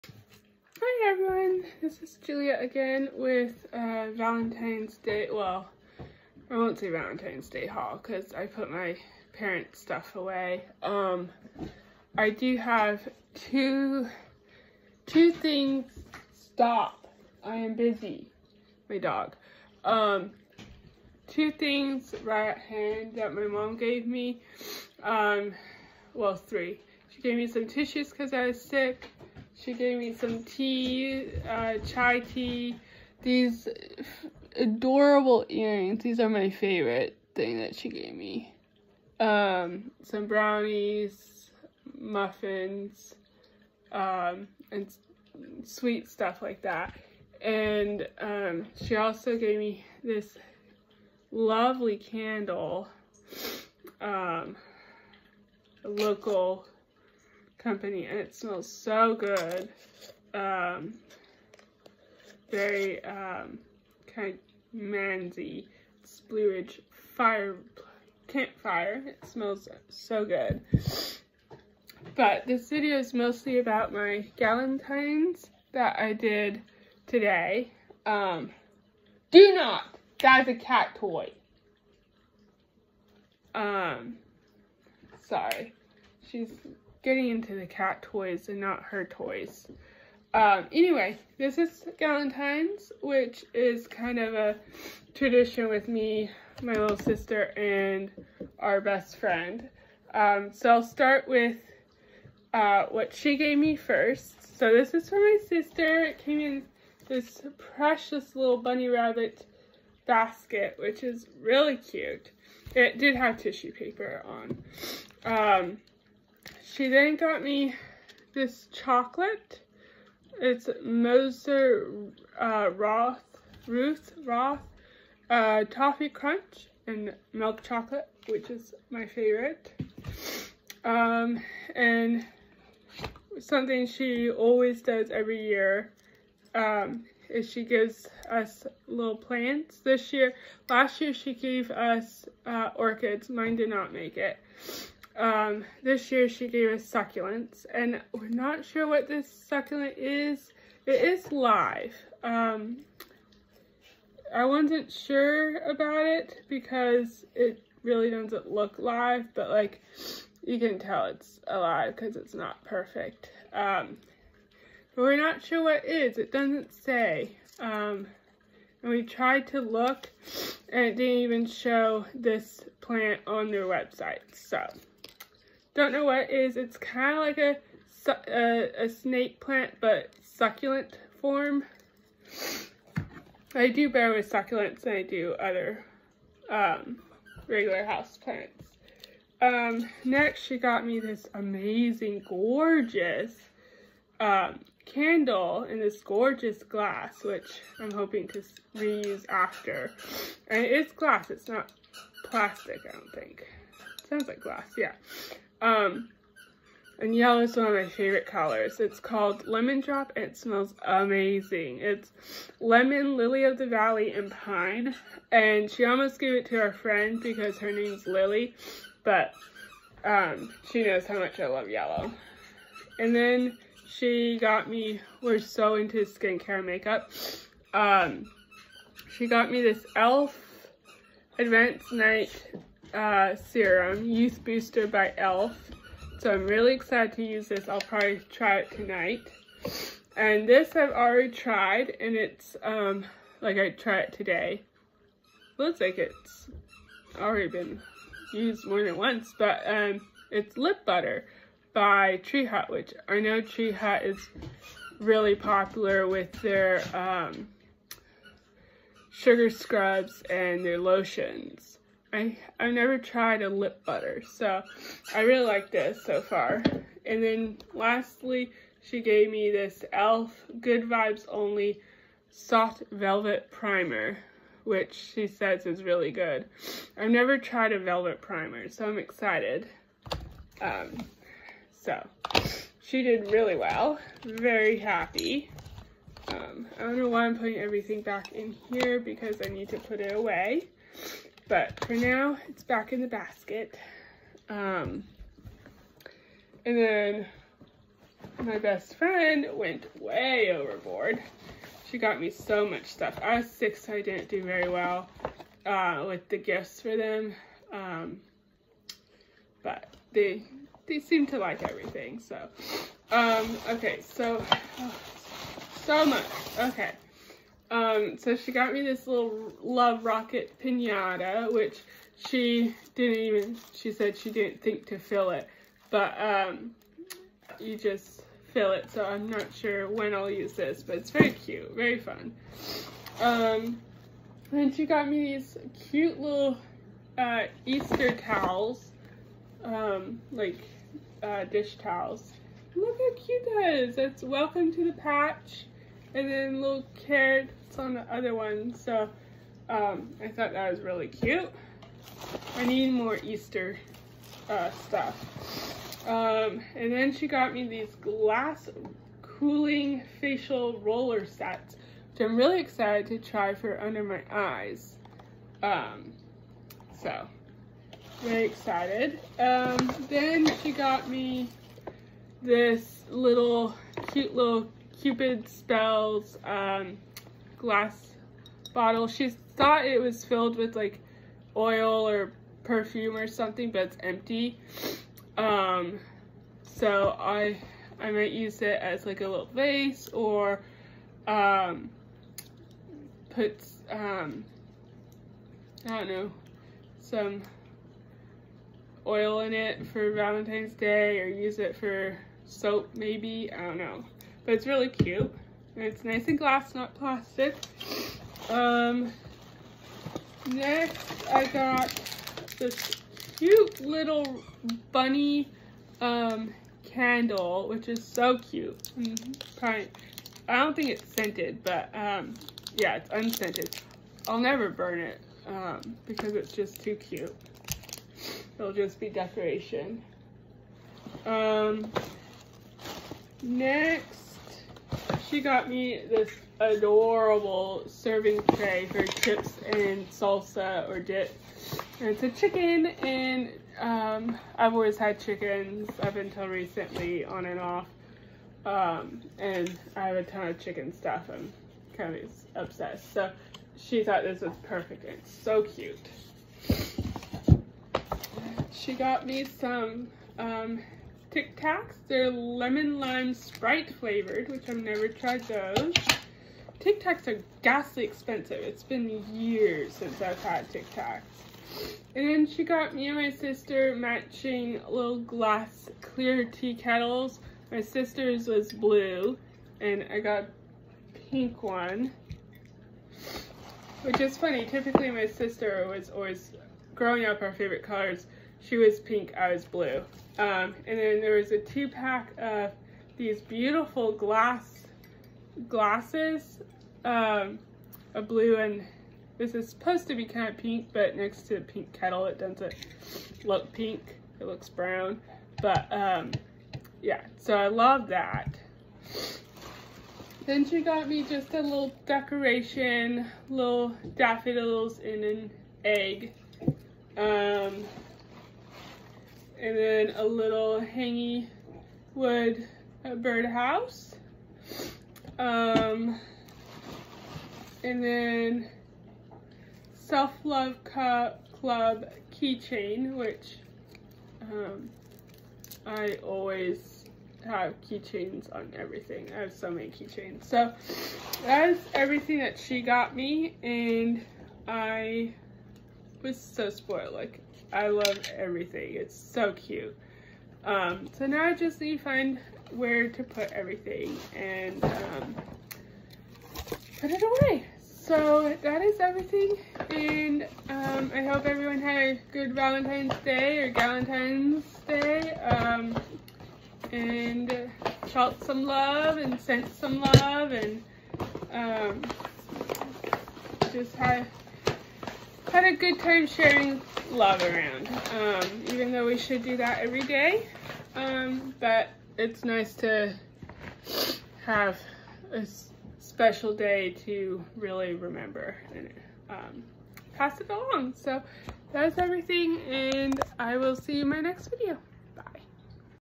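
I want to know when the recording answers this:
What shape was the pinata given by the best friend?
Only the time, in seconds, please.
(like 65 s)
319 s.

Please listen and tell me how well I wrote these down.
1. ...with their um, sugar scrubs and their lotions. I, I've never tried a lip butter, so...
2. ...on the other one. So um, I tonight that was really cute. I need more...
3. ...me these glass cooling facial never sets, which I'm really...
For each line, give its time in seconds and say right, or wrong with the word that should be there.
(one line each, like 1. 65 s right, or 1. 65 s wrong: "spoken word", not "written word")
1. 256 s right
2. 347 s wrong: "thought", not "tonight"
3. 357 s wrong: "roller", not "never".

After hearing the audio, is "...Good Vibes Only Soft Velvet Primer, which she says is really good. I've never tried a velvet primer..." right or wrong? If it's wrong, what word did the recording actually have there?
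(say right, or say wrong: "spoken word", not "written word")
right.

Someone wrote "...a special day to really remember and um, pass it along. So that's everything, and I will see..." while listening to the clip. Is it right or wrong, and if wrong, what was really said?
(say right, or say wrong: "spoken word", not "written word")
right.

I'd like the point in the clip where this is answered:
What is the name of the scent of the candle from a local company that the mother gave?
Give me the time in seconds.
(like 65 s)
66 s.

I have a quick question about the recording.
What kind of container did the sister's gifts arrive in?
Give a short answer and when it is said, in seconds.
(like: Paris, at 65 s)
Bunny rabbit basket, at 108 s.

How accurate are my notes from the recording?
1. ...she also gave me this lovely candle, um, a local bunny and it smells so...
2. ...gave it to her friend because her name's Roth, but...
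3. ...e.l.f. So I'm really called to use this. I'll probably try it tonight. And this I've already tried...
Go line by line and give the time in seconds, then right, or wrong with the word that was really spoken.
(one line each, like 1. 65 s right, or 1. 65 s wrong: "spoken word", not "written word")
1. 48 s wrong: "company", not "bunny"
2. 216 s wrong: "Lily", not "Roth"
3. 235 s wrong: "excited", not "called".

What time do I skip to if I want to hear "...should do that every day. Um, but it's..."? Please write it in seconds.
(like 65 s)
579 s.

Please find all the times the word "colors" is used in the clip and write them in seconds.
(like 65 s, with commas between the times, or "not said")
208 s, 487 s.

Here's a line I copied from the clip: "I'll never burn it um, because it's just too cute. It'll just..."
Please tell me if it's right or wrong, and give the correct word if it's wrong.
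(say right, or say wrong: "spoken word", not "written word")
right.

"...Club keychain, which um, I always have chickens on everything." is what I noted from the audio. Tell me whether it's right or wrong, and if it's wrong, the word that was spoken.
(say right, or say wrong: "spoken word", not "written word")
wrong: "keychains", not "chickens".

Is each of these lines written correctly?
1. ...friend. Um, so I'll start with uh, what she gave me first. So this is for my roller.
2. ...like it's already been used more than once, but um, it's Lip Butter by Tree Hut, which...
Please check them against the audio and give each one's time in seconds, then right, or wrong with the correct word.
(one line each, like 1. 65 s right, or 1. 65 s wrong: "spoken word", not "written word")
1. 99 s wrong: "sister", not "roller"
2. 245 s right.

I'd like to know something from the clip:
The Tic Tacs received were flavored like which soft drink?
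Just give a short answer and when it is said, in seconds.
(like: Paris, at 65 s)
Sprite, at 463 s.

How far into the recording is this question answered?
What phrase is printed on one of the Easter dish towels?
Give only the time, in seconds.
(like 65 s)
344 s.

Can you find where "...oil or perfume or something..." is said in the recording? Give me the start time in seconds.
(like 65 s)
381 s.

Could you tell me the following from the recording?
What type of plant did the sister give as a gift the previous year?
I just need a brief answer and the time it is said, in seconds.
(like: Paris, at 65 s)
Orchids, at 142 s.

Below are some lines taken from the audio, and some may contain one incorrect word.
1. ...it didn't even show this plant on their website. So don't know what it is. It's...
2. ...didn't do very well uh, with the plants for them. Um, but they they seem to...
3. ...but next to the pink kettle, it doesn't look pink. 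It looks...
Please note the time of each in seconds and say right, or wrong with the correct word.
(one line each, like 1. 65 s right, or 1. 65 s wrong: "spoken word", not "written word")
1. 170 s right
2. 304 s wrong: "gifts", not "plants"
3. 500 s right.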